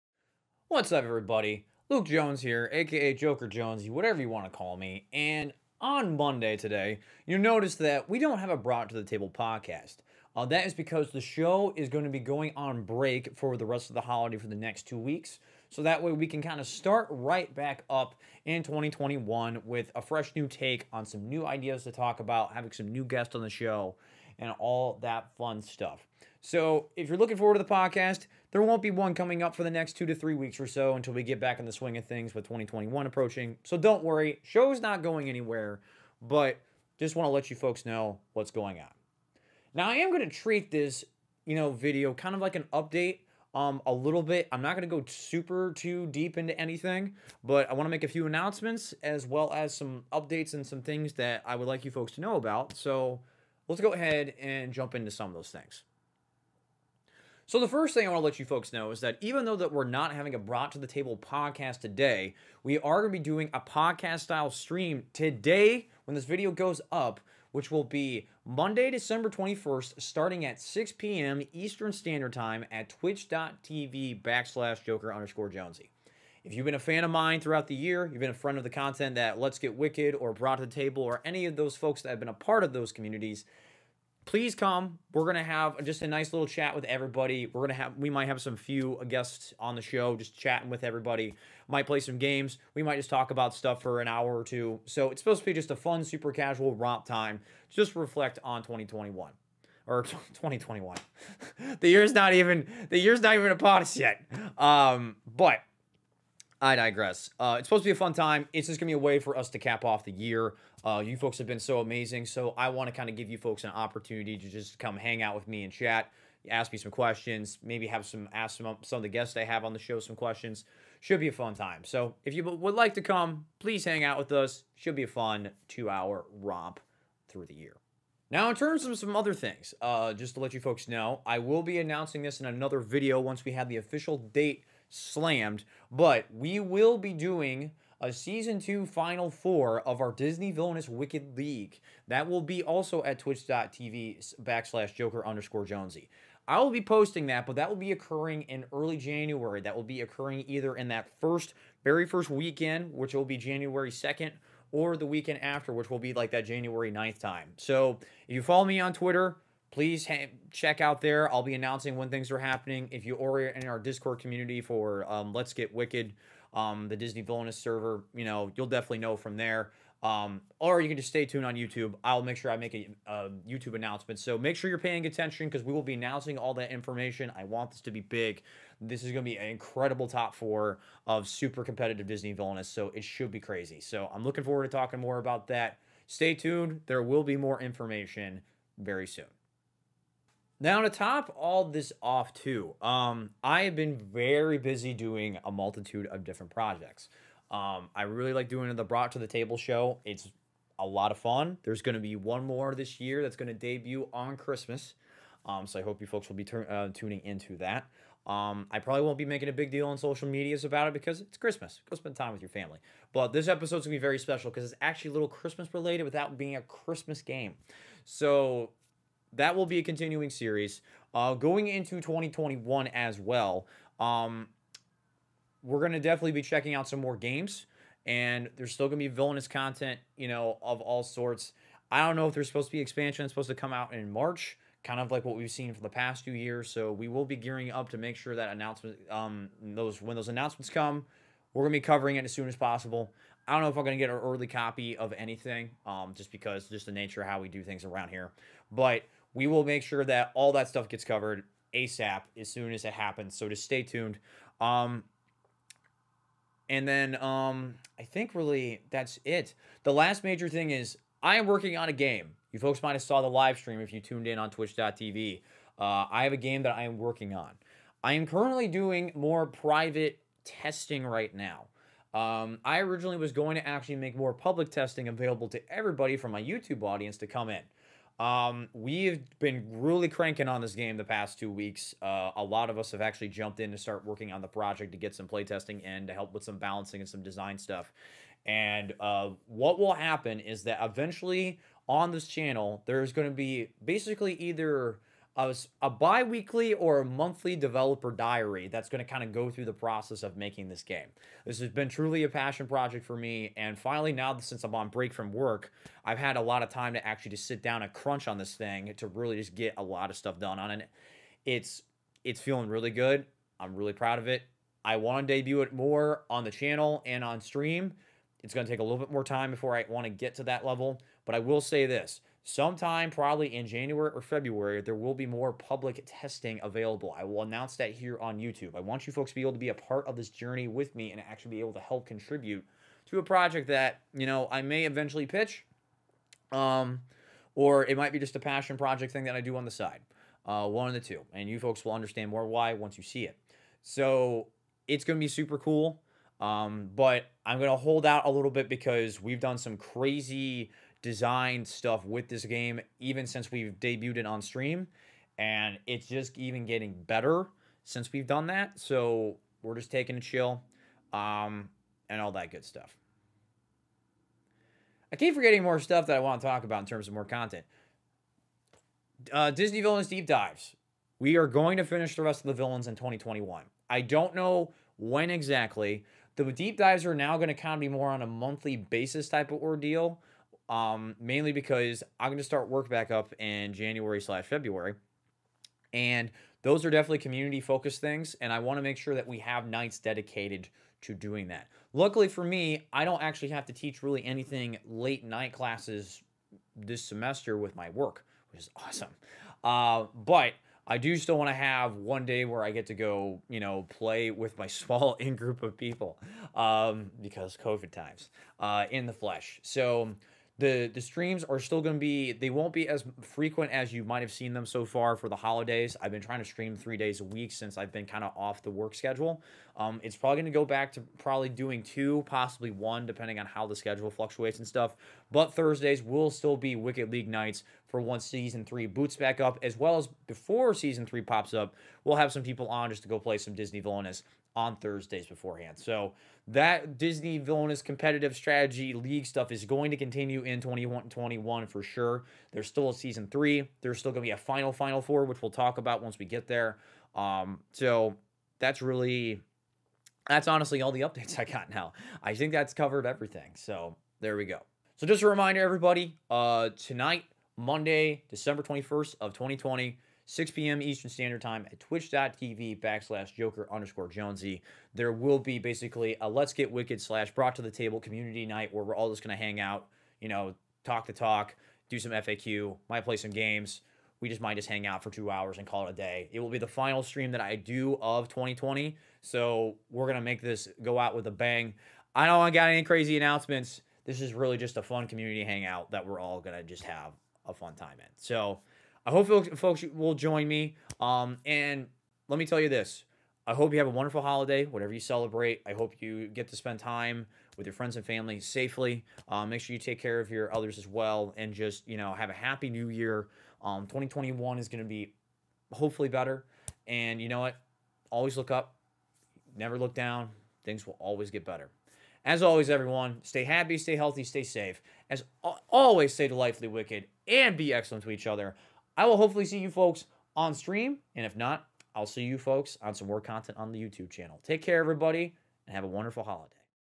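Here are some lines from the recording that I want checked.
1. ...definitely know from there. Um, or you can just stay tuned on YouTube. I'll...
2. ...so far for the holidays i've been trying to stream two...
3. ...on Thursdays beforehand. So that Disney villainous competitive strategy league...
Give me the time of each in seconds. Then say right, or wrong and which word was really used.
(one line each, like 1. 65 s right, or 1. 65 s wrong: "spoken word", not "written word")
1. 168 s right
2. 414 s wrong: "three", not "two"
3. 434 s right.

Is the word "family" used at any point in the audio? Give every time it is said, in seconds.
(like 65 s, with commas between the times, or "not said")
212 s, 498 s.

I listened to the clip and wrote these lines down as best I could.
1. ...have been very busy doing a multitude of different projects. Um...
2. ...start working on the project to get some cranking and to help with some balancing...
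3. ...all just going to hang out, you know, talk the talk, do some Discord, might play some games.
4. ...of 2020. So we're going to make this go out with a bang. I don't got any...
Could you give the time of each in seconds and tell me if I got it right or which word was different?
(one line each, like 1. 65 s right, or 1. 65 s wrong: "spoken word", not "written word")
1. 193 s right
2. 283 s wrong: "playtesting", not "cranking"
3. 468 s wrong: "FAQ", not "Discord"
4. 478 s right.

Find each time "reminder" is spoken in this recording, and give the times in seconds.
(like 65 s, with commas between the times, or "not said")
455 s.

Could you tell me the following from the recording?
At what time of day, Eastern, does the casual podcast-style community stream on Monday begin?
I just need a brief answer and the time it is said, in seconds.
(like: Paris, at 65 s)
6 p.m., at 70 s.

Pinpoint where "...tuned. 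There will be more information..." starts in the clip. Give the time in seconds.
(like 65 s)
186 s.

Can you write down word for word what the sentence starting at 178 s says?
This is going to be an incredible top four of super competitive Disney Villainous.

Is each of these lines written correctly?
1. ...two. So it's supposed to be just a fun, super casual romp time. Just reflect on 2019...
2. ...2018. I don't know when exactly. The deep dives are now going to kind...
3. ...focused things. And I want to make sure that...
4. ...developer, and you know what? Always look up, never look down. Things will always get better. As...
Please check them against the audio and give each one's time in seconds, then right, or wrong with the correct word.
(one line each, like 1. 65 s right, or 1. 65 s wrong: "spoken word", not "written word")
1. 94 s wrong: "2021", not "2019"
2. 372 s wrong: "2021", not "2018"
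3. 387 s right
4. 506 s wrong: "better", not "developer".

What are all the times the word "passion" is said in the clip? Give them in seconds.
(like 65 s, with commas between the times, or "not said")
302 s, 338 s.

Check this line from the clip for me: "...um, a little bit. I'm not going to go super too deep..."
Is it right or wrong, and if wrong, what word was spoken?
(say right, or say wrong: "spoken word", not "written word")
right.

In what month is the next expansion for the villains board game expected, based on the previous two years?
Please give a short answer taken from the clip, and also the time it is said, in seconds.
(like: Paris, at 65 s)
March, at 232 s.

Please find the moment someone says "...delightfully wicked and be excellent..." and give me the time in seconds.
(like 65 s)
516 s.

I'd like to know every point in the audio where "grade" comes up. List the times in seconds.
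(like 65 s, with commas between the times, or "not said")
not said.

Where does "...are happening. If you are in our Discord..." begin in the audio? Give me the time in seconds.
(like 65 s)
162 s.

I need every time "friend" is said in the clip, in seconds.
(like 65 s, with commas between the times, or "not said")
78 s, 497 s.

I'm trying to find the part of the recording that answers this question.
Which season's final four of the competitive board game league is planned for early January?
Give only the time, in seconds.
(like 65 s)
138 s.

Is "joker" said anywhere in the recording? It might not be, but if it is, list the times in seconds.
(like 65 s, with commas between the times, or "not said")
3 s, 74 s, 144 s, 463 s.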